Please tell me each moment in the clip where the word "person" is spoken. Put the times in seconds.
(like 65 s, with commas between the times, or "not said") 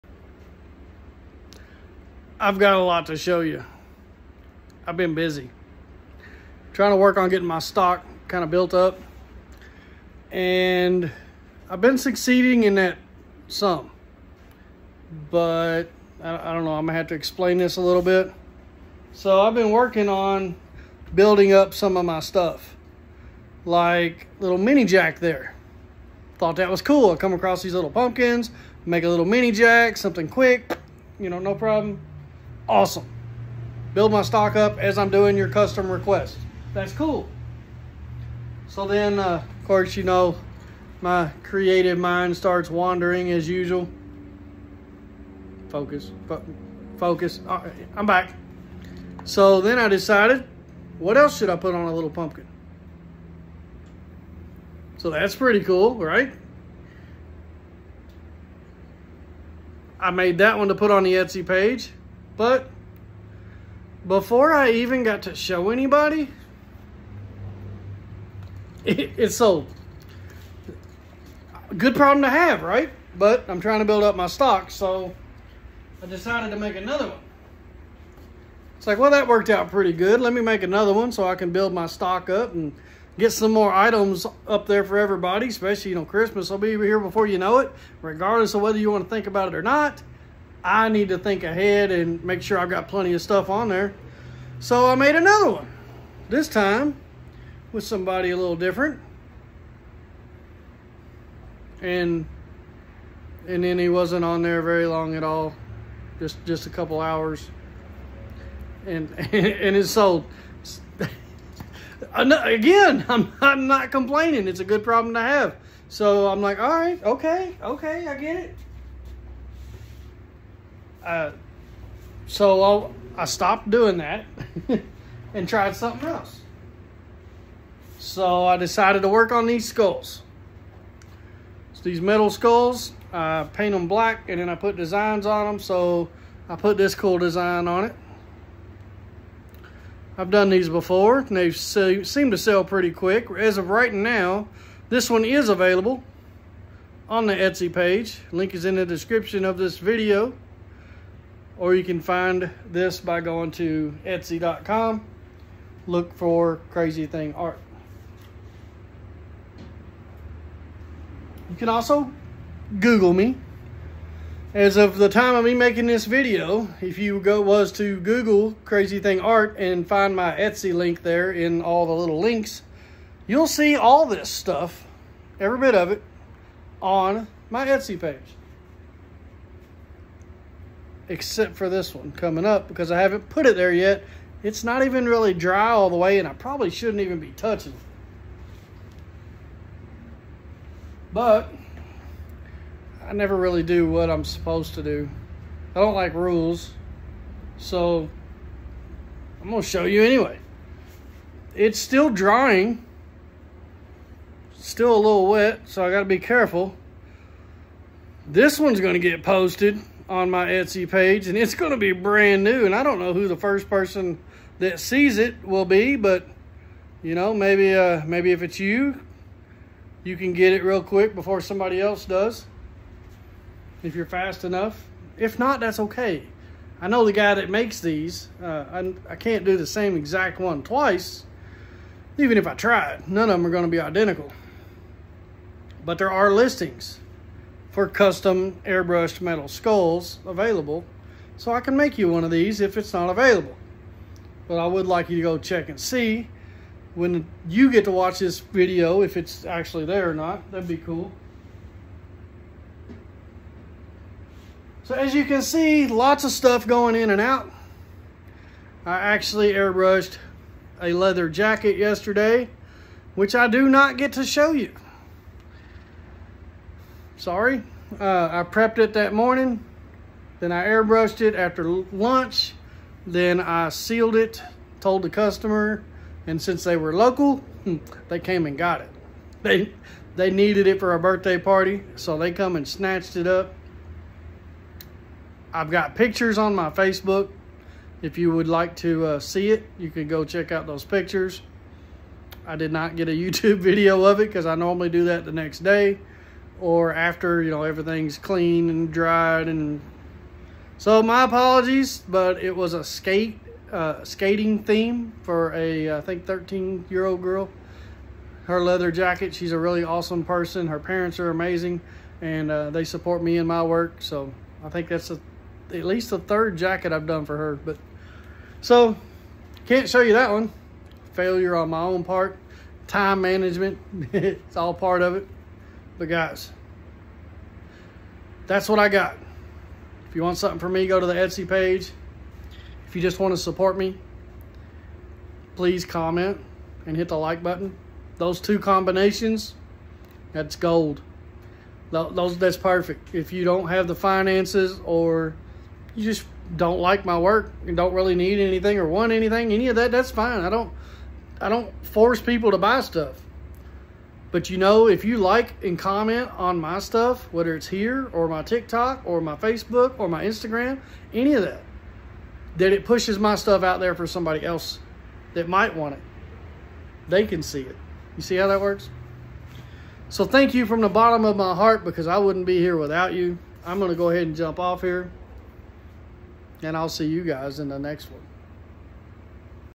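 213 s, 310 s.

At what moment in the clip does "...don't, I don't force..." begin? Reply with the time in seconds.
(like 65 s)
350 s.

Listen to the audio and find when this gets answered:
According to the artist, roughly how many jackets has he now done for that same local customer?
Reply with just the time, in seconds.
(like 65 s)
316 s.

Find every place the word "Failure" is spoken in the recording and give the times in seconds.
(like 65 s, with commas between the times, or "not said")
321 s.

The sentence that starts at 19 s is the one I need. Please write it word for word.
So I've been working on building up some of my stuff.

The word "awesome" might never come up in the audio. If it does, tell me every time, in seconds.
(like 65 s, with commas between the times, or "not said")
32 s, 309 s.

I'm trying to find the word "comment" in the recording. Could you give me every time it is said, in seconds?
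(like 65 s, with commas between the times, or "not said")
335 s, 355 s.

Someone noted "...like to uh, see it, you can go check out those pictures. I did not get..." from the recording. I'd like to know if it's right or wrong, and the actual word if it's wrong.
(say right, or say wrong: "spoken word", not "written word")
right.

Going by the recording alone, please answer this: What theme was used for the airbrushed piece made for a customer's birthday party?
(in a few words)
Skating.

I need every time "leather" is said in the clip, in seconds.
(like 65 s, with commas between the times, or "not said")
260 s, 308 s.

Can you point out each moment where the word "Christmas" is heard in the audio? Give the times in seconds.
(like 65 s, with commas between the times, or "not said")
86 s.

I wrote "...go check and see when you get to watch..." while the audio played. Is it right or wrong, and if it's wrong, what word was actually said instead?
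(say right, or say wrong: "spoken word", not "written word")
right.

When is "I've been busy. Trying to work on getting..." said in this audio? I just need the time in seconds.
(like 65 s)
4 s.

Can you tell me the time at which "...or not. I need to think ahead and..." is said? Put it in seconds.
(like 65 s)
89 s.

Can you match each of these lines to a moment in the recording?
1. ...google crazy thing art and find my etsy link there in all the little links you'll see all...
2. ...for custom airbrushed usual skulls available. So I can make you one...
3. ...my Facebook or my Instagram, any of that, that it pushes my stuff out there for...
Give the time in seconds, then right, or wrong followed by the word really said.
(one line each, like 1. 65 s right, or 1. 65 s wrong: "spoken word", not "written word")
1. 167 s right
2. 237 s wrong: "metal", not "usual"
3. 359 s right.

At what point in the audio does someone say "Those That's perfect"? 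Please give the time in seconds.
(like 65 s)
341 s.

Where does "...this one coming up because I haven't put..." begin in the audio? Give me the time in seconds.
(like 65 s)
181 s.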